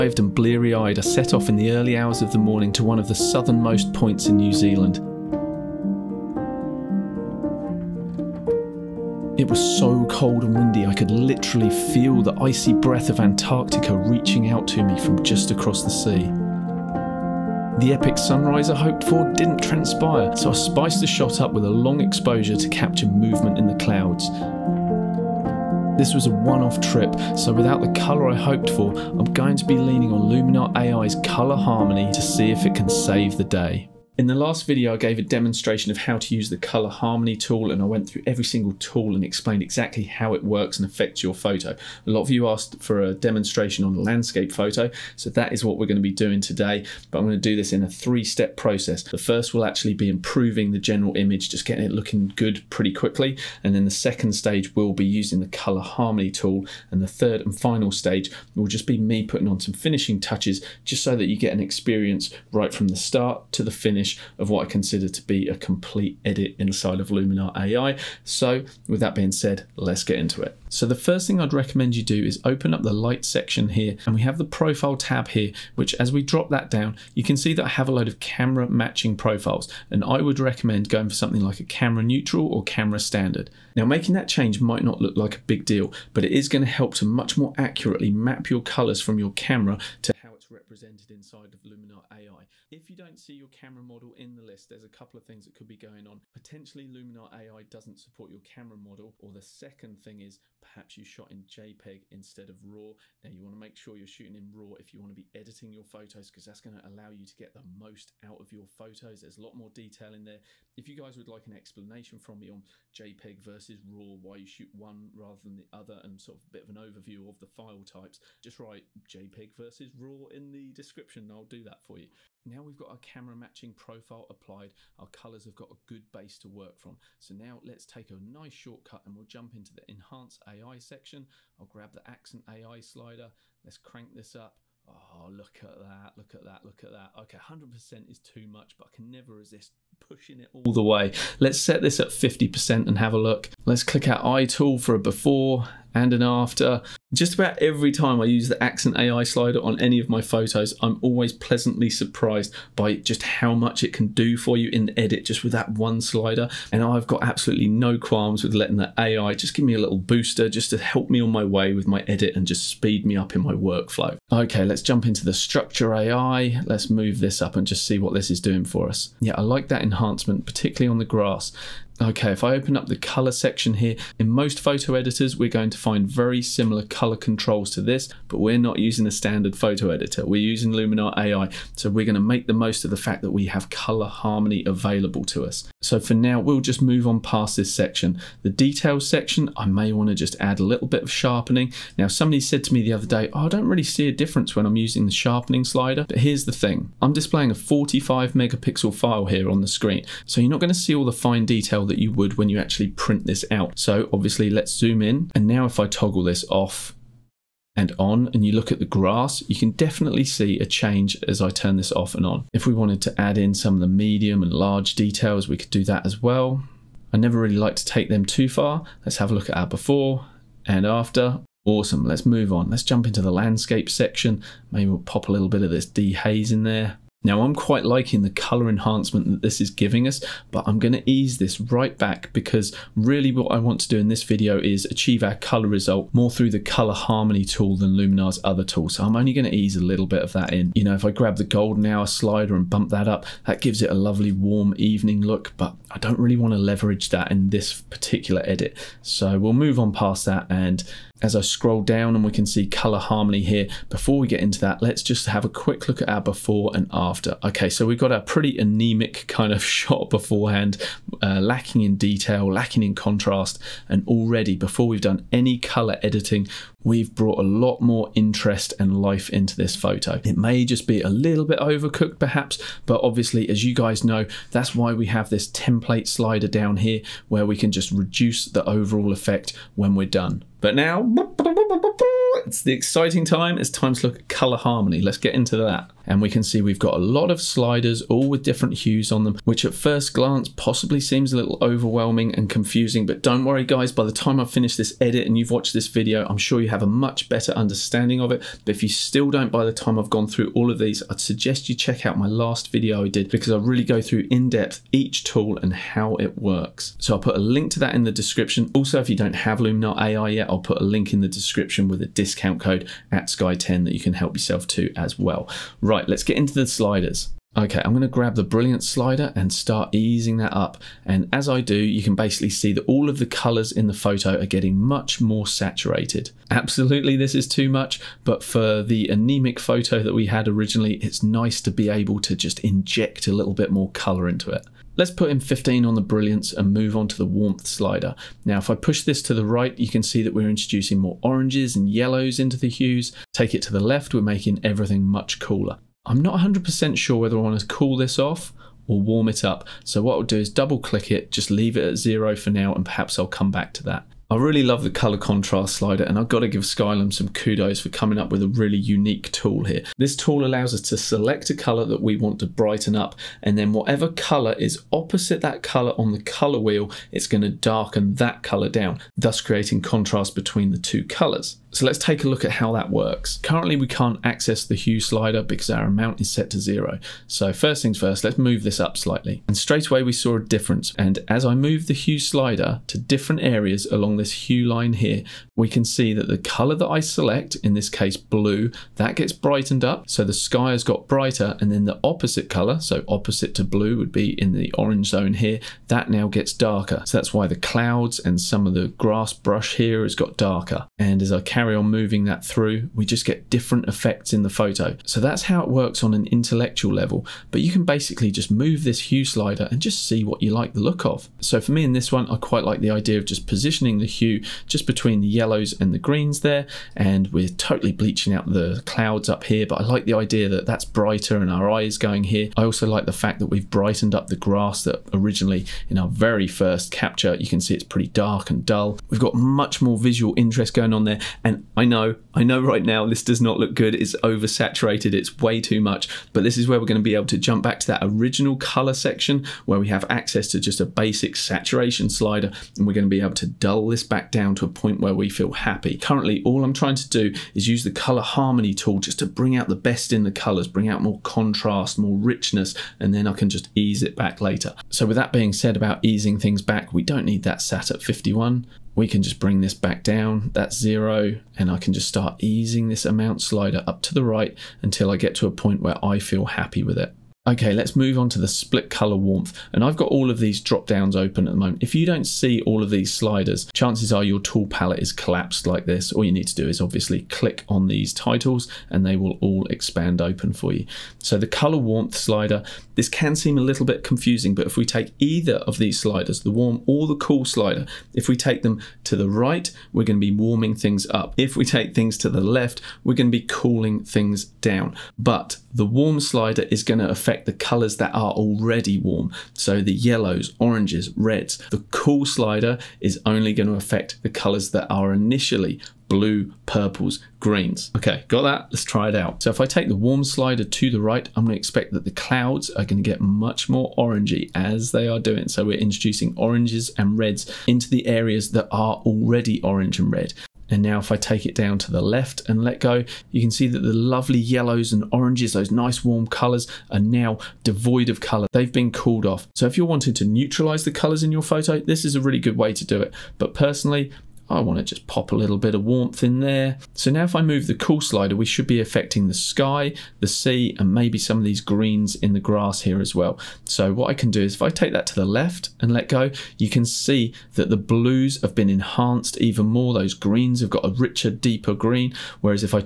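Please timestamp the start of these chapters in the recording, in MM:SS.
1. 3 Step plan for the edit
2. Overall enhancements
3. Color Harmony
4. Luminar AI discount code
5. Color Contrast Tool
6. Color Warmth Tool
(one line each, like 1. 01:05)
1. 00:47
2. 01:11
3. 04:42
4. 05:13
5. 06:12
6. 07:59.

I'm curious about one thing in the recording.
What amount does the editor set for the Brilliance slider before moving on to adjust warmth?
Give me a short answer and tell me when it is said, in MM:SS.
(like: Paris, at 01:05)
15, at 05:35.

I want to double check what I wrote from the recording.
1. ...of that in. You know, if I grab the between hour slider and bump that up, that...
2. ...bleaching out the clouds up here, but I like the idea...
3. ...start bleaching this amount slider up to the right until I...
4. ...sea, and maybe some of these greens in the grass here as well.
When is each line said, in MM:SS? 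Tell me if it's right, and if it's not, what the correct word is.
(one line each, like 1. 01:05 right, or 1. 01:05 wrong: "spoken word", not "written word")
1. 04:00 wrong: "golden", not "between"
2. 06:57 right
3. 07:42 wrong: "easing", not "bleaching"
4. 09:00 right.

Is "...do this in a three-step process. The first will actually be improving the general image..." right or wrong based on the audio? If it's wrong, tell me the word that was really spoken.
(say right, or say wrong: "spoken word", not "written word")
right.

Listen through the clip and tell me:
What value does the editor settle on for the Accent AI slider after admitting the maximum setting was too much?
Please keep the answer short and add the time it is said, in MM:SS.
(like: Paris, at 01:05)
50%, at 02:22.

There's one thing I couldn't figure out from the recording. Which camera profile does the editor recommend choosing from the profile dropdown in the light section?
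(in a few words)
Camera Neutral.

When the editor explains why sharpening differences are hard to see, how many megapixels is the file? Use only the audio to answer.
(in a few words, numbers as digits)
45.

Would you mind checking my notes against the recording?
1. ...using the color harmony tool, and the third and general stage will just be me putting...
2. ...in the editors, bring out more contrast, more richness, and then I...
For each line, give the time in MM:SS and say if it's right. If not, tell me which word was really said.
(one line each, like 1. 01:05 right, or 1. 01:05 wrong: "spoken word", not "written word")
1. 00:55 wrong: "final", not "general"
2. 07:30 wrong: "colors", not "editors".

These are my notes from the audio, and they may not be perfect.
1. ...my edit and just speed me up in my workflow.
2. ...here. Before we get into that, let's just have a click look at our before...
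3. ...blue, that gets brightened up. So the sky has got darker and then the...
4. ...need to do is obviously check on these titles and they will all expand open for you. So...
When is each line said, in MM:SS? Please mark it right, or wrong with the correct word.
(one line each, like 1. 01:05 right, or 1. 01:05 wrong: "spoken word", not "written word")
1. 02:41 right
2. 04:13 wrong: "quick", not "click"
3. 06:28 wrong: "brighter", not "darker"
4. 07:56 wrong: "click", not "check".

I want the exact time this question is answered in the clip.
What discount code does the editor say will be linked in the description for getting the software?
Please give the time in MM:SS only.
05:13.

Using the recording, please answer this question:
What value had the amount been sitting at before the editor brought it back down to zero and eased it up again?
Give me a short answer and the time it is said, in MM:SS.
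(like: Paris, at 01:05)
51, at 07:38.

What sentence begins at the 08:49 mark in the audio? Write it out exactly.
So if you're wanting to neutralize the colors in your photo, this is a really good way to do it.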